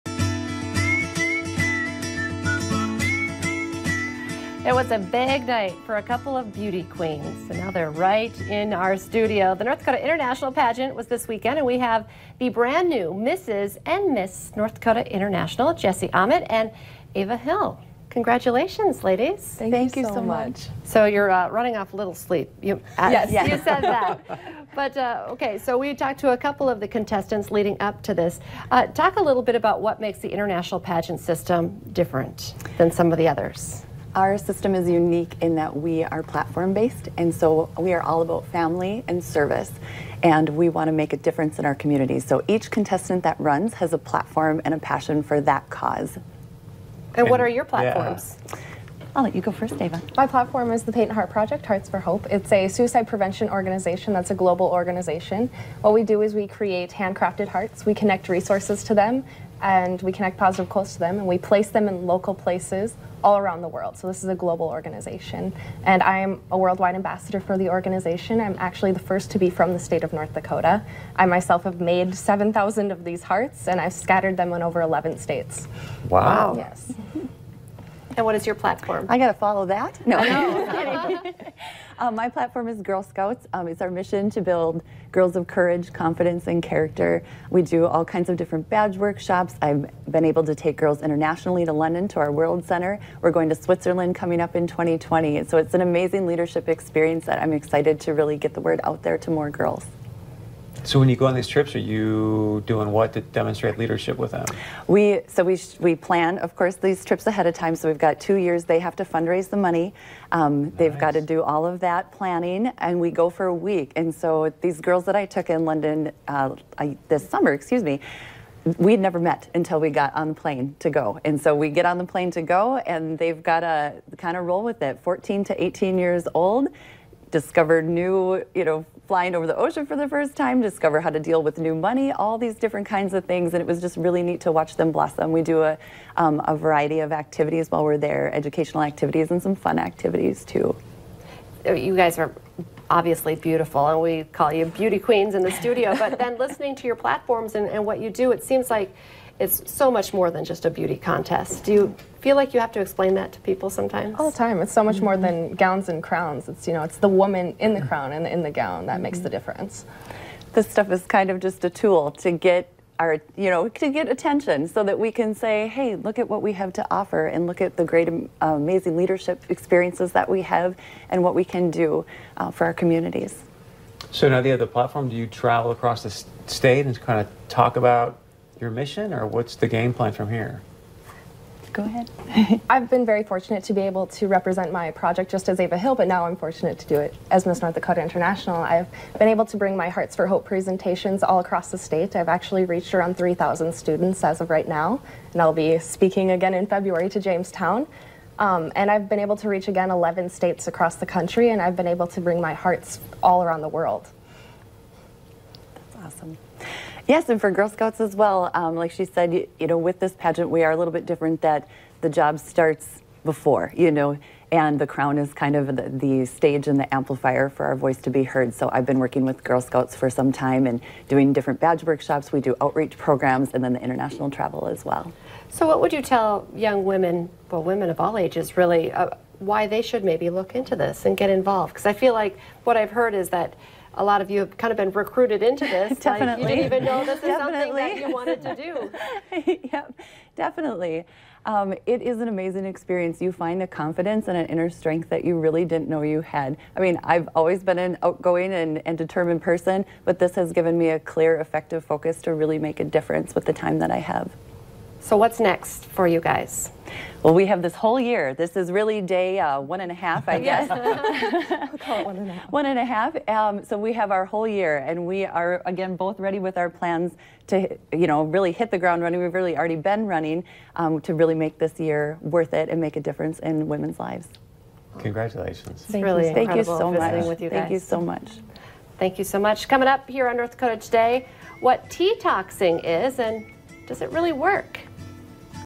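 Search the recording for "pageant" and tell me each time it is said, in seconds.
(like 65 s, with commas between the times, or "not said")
10 s, 30 s, 210 s.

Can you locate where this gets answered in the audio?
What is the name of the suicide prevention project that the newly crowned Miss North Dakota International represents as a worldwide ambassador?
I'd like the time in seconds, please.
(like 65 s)
50 s.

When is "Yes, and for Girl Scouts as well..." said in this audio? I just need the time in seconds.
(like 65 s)
207 s.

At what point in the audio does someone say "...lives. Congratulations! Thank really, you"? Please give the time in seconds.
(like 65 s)
273 s.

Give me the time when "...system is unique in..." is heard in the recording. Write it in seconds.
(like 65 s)
34 s.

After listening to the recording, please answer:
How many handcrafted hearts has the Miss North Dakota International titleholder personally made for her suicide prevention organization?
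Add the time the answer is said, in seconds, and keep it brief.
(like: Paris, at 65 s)
7,000, at 72 s.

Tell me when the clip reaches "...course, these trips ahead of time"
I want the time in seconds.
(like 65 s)
106 s.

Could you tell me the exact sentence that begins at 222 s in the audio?
We do outreach programs and then the international travel as well.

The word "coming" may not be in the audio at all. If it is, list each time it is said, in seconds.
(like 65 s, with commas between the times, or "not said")
94 s, 279 s.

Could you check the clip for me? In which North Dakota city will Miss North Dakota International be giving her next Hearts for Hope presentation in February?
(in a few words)
Jamestown.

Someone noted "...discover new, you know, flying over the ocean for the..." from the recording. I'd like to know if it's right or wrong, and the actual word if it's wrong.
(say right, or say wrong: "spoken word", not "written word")
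right.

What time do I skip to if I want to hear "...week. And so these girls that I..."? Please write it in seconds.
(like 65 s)
113 s.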